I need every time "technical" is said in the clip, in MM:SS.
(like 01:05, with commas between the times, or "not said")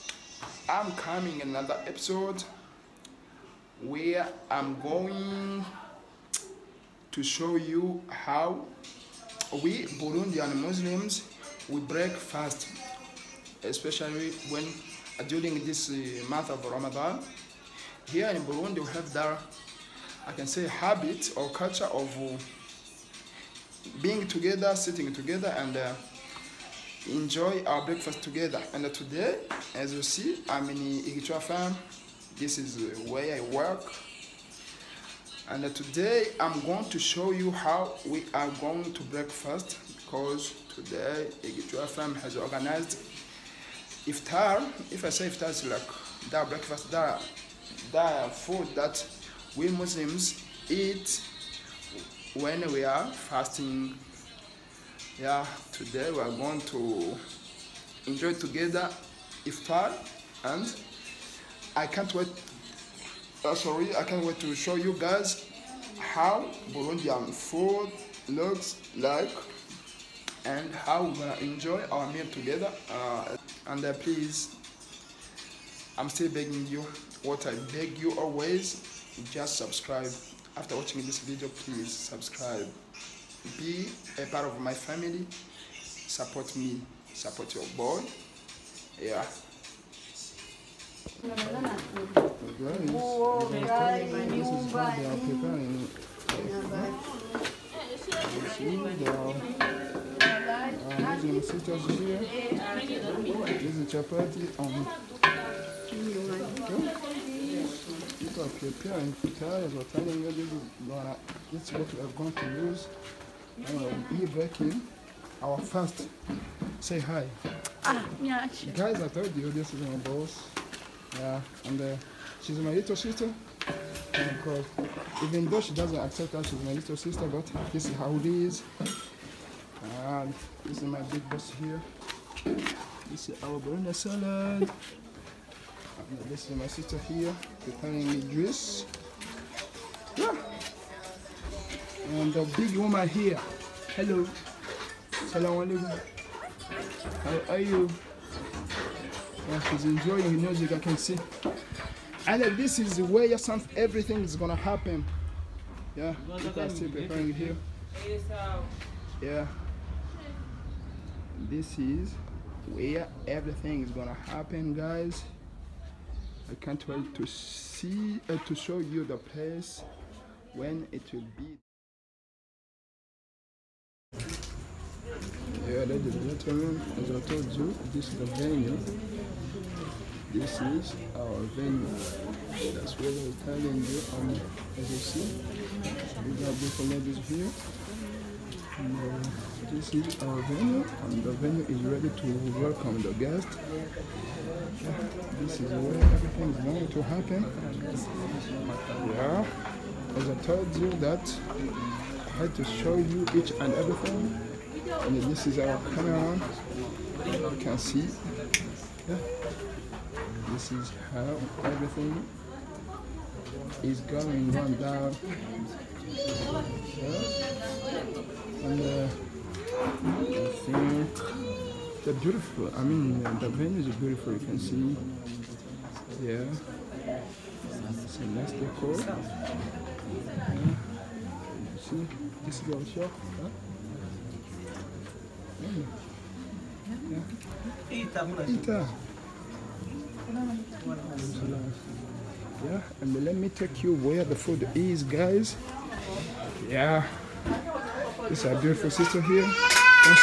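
not said.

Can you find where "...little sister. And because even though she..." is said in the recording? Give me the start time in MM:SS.
02:02.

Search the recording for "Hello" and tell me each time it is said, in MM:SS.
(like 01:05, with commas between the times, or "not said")
02:23.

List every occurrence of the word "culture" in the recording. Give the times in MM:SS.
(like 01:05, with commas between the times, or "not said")
00:21.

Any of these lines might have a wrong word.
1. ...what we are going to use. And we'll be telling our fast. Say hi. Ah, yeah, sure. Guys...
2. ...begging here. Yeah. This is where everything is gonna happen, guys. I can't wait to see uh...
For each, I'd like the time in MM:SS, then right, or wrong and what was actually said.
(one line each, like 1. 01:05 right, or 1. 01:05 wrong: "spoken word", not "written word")
1. 01:51 wrong: "breaking", not "telling"
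2. 02:36 wrong: "preparing", not "begging".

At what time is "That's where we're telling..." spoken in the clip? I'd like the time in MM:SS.
03:02.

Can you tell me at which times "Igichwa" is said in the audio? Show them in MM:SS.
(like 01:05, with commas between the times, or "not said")
00:30, 00:41.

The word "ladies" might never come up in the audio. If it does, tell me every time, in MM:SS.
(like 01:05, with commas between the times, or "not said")
02:55, 03:06.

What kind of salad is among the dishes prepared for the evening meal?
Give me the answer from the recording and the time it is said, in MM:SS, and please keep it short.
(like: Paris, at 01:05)
Banana salad, at 02:13.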